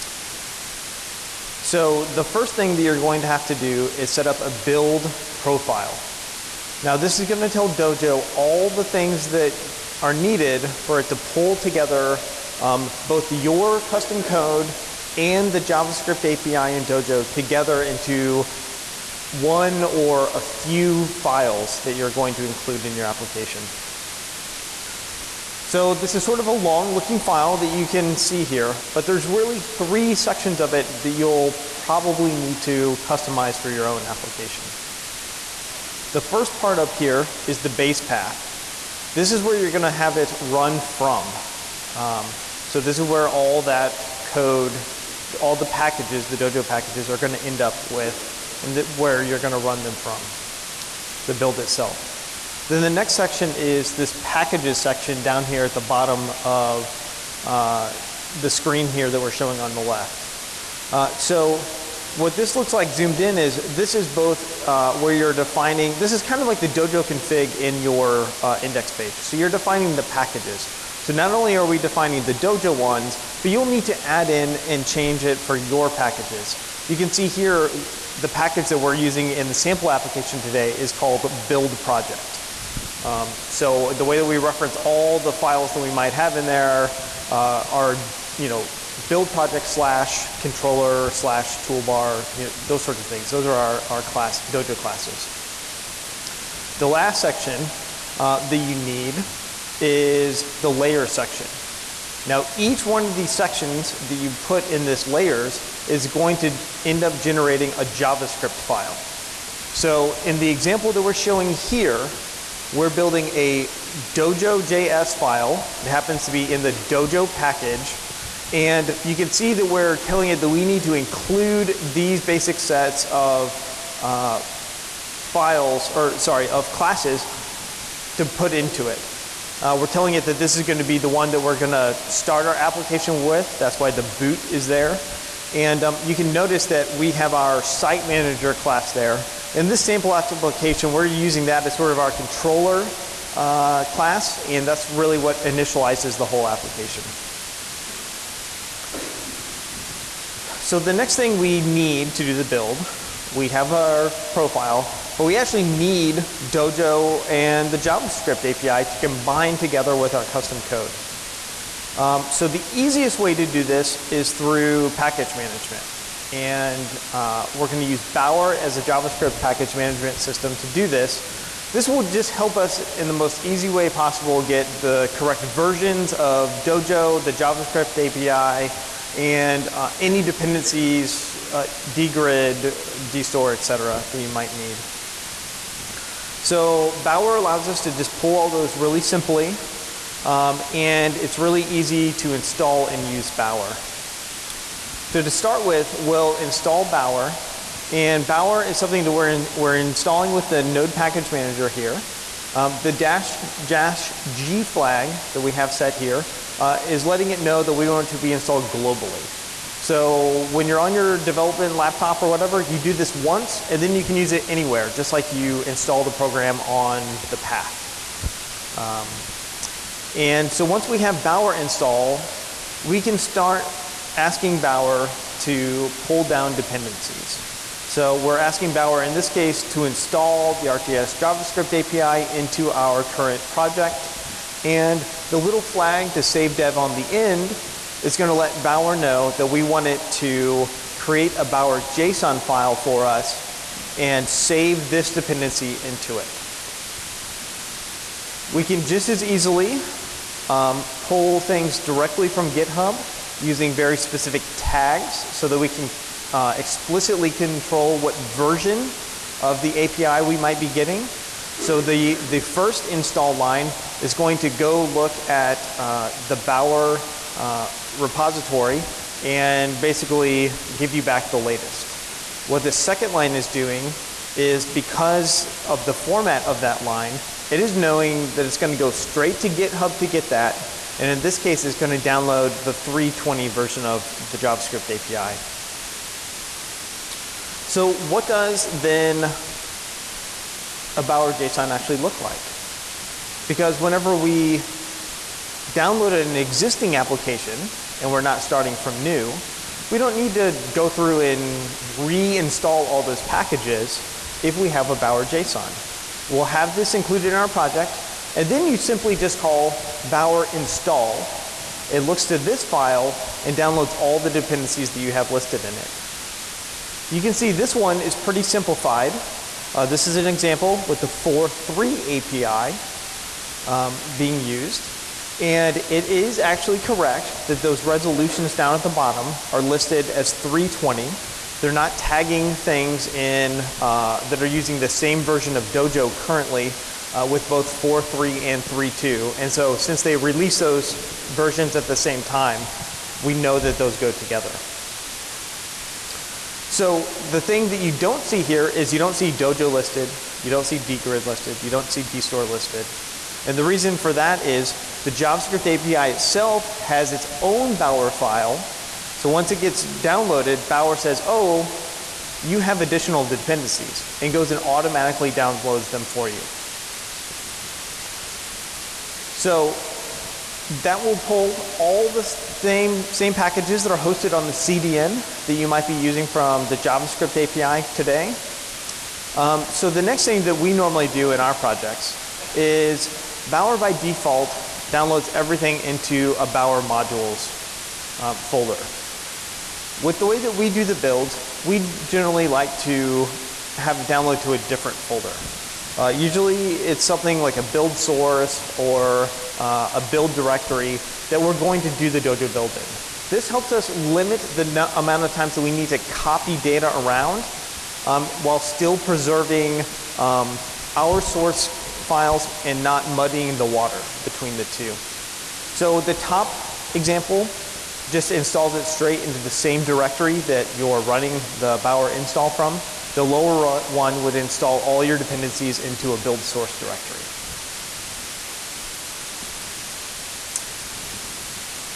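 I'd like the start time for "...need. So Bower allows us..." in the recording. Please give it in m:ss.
3:04.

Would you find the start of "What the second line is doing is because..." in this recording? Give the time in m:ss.
4:32.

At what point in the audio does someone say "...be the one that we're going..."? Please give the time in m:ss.
2:10.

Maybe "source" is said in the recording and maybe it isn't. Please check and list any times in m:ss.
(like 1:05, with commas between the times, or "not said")
6:37, 6:51, 7:06.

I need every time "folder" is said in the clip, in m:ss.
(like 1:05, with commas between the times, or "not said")
6:28, 6:35.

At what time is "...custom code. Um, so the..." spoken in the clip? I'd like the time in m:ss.
2:40.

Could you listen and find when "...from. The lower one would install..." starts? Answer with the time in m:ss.
7:02.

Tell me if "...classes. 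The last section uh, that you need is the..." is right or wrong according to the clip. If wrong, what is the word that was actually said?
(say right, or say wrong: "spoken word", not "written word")
right.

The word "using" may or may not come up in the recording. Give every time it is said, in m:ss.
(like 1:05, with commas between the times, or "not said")
1:18, 2:21, 4:13, 5:34, 6:15.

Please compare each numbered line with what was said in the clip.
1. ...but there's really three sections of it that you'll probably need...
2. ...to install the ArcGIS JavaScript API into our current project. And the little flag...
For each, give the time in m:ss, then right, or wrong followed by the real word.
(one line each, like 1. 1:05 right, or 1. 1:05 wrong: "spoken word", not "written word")
1. 0:28 right
2. 3:49 right.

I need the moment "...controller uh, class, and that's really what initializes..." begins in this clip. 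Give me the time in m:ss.
2:22.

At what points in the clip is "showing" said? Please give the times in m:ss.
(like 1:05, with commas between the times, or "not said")
0:59, 1:51.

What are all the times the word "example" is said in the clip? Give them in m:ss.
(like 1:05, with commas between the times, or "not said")
1:50, 5:20, 6:56.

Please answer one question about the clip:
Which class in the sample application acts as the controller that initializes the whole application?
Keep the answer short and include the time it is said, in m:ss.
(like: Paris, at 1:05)
site manager, at 2:17.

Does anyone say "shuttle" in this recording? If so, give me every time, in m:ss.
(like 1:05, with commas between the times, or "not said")
not said.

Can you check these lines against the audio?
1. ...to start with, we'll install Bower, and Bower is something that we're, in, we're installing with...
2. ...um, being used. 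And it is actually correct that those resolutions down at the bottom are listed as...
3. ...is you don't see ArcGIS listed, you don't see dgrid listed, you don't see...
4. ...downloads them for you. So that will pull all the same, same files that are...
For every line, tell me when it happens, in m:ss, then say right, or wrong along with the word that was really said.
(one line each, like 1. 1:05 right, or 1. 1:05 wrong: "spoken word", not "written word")
1. 3:15 right
2. 5:23 right
3. 5:48 wrong: "Dojo", not "ArcGIS"
4. 6:05 wrong: "packages", not "files".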